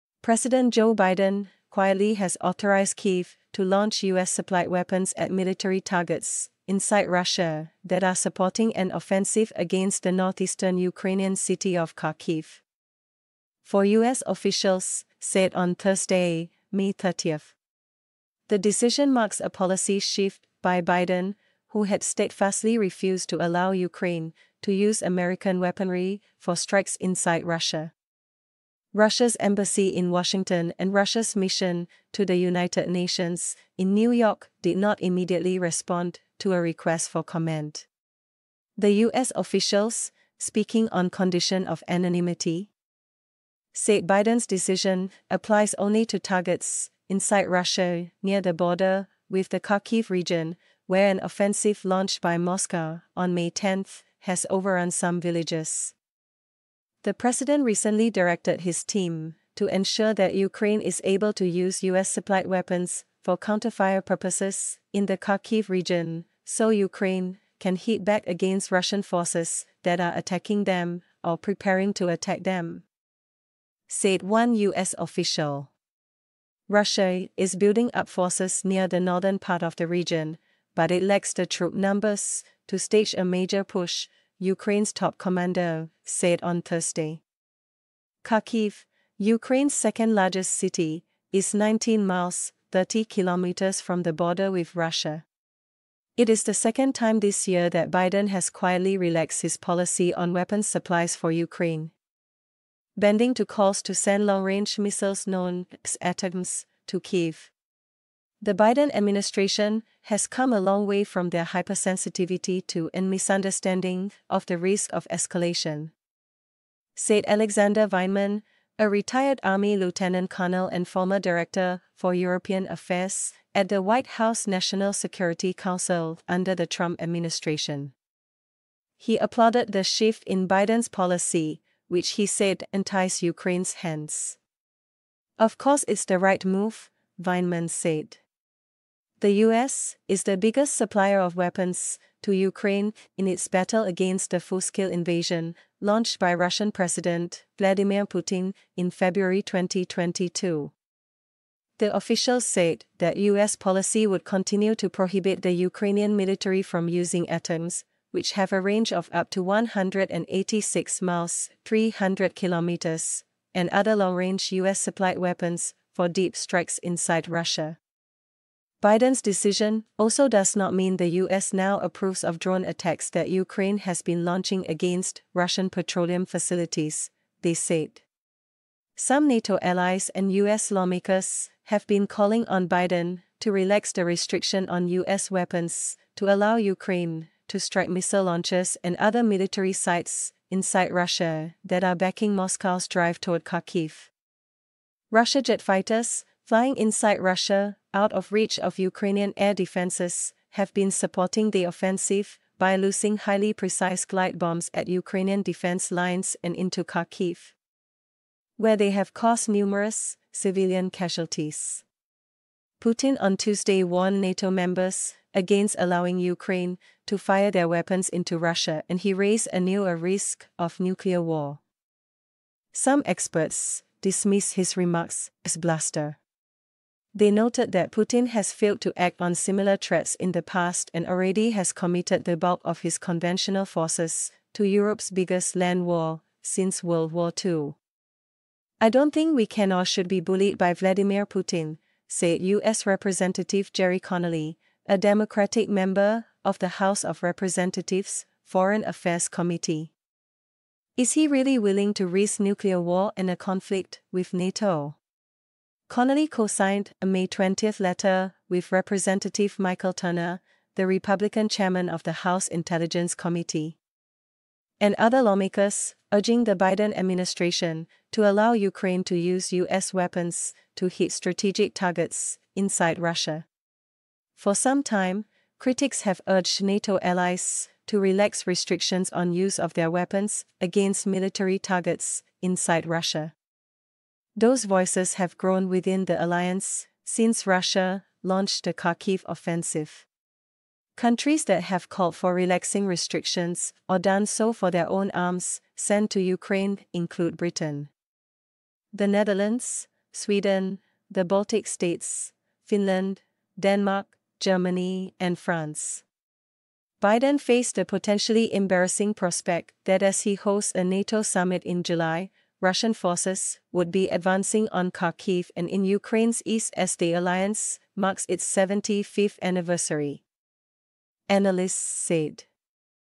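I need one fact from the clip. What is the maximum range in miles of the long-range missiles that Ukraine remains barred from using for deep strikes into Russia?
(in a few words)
186 miles.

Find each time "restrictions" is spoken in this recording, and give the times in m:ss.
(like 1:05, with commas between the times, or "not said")
3:04, 4:38, 4:52.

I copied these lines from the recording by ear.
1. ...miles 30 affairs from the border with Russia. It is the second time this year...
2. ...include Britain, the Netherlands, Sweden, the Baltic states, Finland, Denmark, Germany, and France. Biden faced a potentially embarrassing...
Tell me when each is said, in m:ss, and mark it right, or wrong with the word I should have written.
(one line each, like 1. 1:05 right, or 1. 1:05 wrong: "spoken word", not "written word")
1. 1:32 wrong: "kilometers", not "affairs"
2. 4:56 right.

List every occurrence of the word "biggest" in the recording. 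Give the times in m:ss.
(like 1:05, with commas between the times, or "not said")
2:20, 3:55.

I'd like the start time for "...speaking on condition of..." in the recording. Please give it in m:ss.
0:40.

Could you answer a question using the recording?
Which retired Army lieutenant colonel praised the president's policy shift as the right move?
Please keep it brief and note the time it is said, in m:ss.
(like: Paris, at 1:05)
Alexander Vindman, at 1:57.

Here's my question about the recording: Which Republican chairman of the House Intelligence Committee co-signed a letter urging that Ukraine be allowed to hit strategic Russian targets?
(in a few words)
Michael Turner.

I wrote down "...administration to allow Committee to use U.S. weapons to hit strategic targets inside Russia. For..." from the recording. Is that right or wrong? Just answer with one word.
wrong.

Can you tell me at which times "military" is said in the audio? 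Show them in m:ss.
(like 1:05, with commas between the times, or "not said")
0:05, 2:36, 3:09, 4:41.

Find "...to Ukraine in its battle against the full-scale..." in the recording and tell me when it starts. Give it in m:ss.
2:22.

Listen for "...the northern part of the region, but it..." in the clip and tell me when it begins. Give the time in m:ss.
1:18.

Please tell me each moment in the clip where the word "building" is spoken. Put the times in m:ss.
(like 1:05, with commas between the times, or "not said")
1:17.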